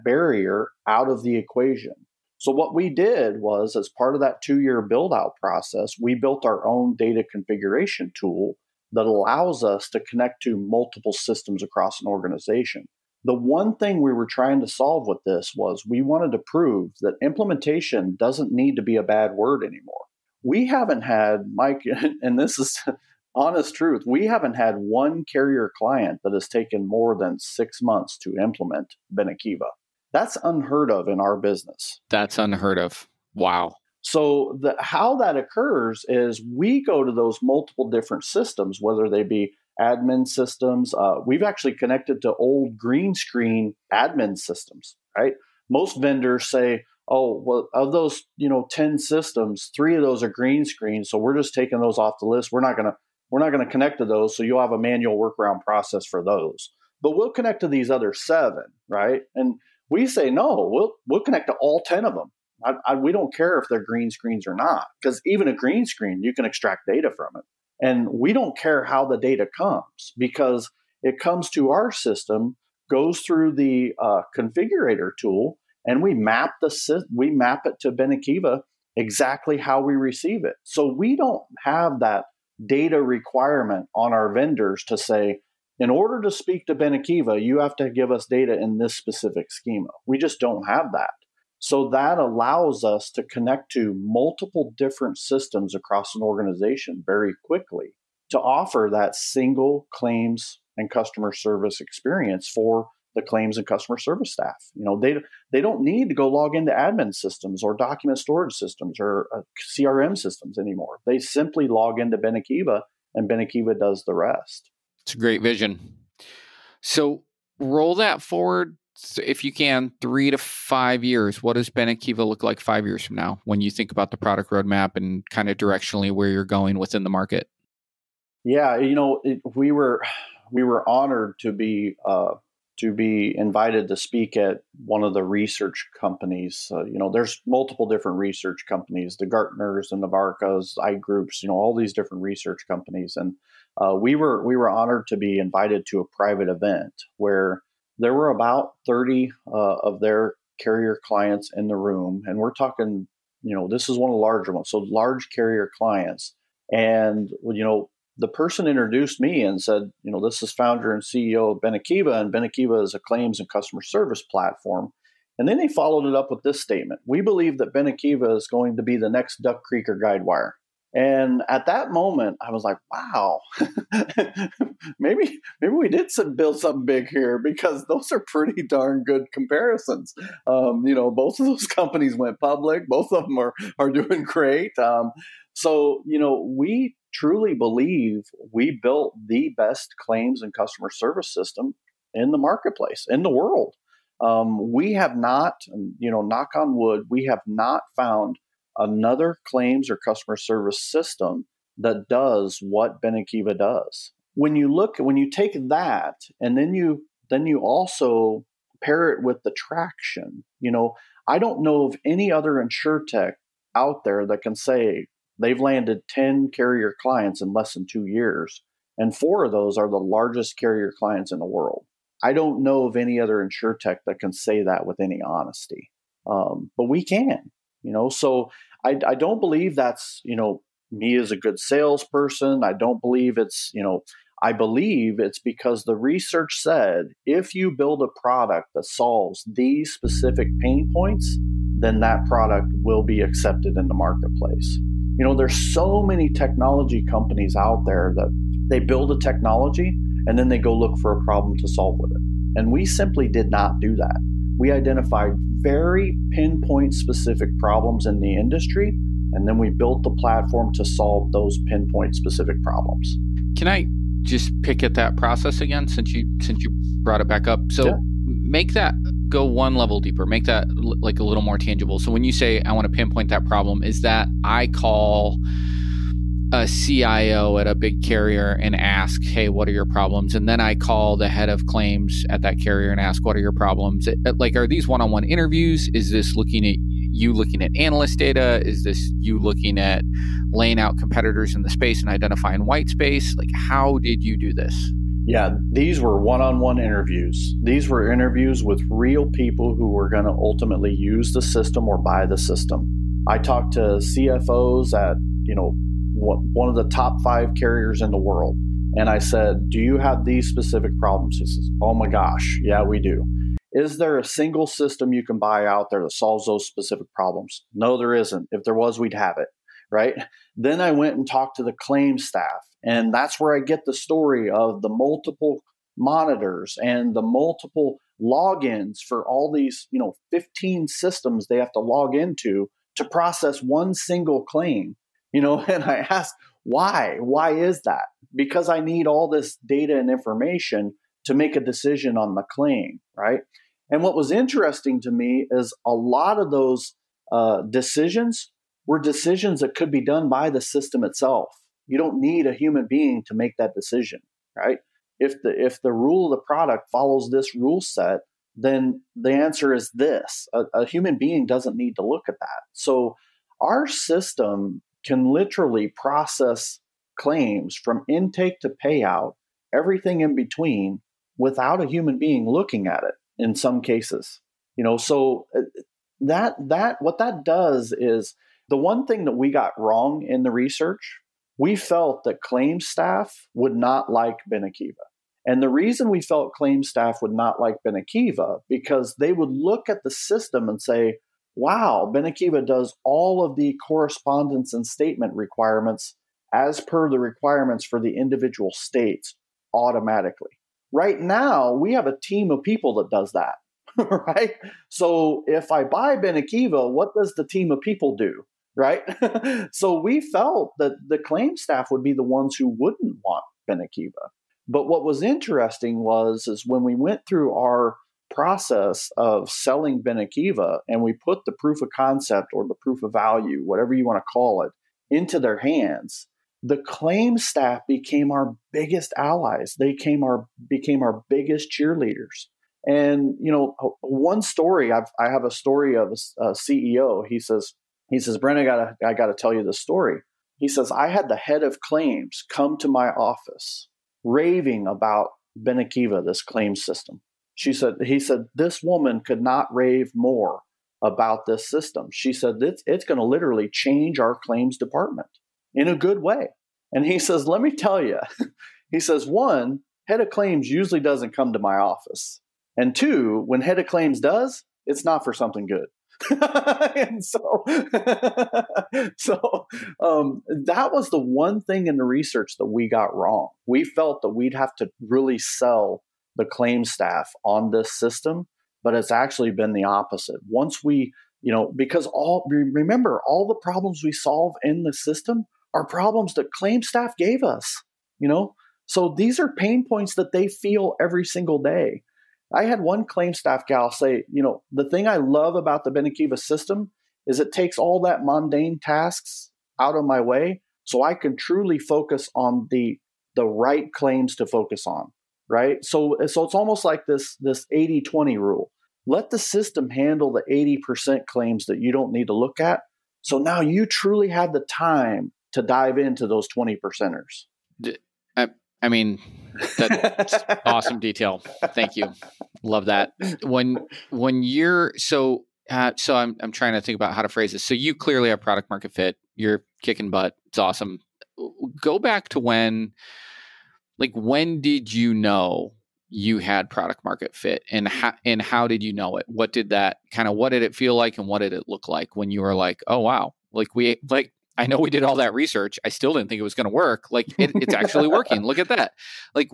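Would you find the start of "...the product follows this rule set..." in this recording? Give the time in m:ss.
5:56.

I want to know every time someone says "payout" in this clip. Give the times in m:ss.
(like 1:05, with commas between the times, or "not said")
6:08.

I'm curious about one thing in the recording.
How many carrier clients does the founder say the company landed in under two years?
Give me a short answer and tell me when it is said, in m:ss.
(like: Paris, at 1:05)
10, at 3:36.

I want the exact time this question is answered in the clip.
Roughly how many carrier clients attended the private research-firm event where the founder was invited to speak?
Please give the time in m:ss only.
2:28.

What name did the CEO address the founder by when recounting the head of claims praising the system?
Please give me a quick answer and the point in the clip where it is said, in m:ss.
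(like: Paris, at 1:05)
Brenda, at 7:18.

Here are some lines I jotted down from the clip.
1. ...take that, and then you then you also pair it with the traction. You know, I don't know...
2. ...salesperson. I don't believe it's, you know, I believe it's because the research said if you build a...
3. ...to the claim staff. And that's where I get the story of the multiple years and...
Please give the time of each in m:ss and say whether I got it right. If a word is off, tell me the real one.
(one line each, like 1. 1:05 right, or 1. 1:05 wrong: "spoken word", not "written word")
1. 3:25 right
2. 3:51 right
3. 5:21 wrong: "monitors", not "years".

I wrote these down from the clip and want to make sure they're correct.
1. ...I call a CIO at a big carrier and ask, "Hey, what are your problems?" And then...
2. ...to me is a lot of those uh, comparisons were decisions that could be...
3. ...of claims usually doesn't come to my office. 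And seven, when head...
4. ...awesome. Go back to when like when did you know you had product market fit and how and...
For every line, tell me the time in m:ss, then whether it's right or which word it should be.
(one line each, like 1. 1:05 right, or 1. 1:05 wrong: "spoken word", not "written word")
1. 4:34 right
2. 5:45 wrong: "decisions", not "comparisons"
3. 7:40 wrong: "two", not "seven"
4. 8:50 right.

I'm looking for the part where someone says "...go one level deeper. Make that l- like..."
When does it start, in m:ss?
4:29.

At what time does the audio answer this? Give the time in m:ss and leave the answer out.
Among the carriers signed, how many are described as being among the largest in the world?
3:39.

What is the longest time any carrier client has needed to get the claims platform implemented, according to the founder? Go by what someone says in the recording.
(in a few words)
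6 months.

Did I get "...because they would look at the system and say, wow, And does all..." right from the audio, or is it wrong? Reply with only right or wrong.
wrong.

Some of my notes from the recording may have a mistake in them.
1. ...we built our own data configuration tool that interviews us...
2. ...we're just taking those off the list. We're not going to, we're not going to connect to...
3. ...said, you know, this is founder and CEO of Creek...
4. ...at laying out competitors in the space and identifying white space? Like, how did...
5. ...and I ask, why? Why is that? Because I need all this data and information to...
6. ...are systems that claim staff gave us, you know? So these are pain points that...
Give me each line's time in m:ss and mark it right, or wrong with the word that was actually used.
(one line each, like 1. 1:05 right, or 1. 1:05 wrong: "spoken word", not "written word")
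1. 0:06 wrong: "allows", not "interviews"
2. 0:51 right
3. 2:39 wrong: "Benekiva", not "Creek"
4. 4:49 right
5. 5:35 right
6. 8:05 wrong: "problems", not "systems".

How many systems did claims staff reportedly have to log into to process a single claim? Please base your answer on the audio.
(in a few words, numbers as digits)
15.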